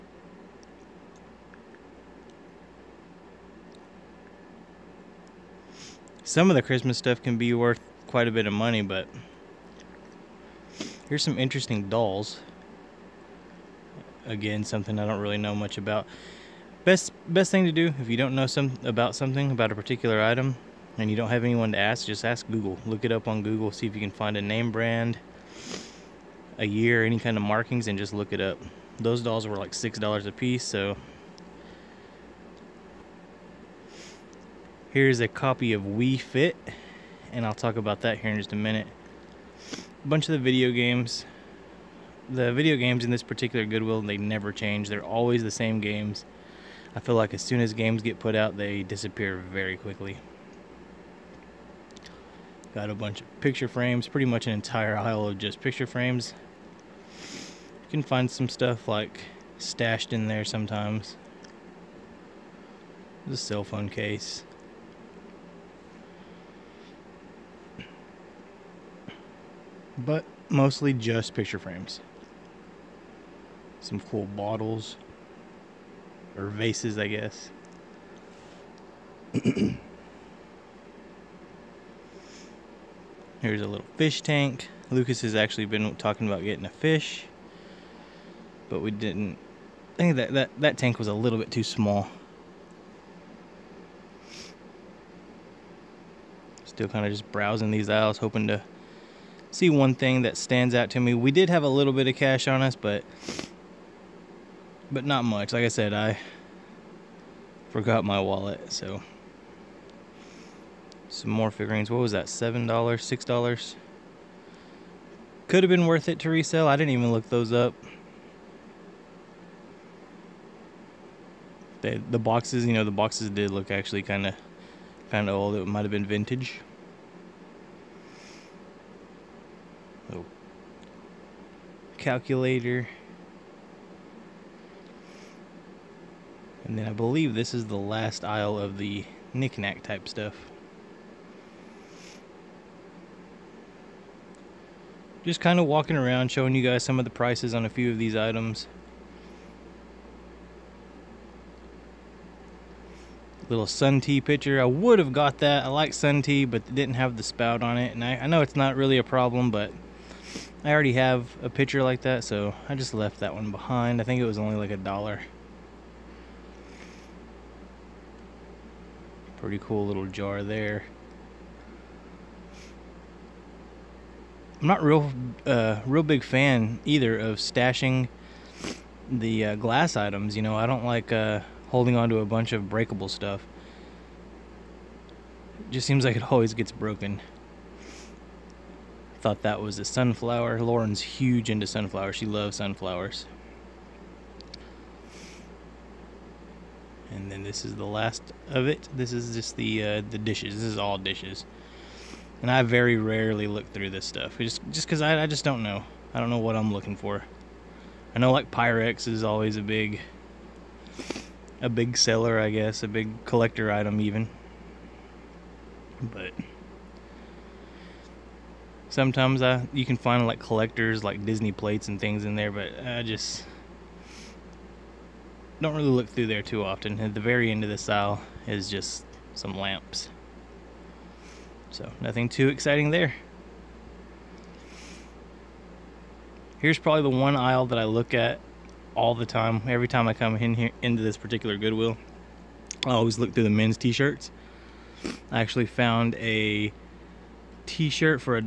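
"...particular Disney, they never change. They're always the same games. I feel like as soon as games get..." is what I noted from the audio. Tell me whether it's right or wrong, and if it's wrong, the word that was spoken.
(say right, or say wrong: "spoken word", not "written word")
wrong: "Goodwill", not "Disney".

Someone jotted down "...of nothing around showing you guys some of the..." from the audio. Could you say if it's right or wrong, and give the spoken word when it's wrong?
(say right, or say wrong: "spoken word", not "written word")
wrong: "walking", not "nothing".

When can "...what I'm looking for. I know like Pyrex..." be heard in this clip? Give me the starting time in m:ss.
3:26.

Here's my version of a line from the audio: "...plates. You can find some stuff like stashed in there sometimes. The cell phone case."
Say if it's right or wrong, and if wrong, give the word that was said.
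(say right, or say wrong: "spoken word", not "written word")
wrong: "frames", not "plates".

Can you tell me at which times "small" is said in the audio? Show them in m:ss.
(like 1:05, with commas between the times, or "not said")
1:31.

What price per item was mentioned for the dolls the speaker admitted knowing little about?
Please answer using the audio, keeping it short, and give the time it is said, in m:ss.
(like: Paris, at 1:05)
$6, at 0:29.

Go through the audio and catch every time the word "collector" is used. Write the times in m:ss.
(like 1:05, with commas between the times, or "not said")
3:33, 3:40.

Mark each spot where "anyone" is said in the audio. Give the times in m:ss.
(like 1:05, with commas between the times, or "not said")
0:21.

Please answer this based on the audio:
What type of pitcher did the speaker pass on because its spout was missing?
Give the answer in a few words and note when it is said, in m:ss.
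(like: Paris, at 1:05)
Sun tea pitcher, at 2:33.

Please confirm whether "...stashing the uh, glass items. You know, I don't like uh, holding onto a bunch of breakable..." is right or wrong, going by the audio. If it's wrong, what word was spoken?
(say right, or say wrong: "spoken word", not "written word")
right.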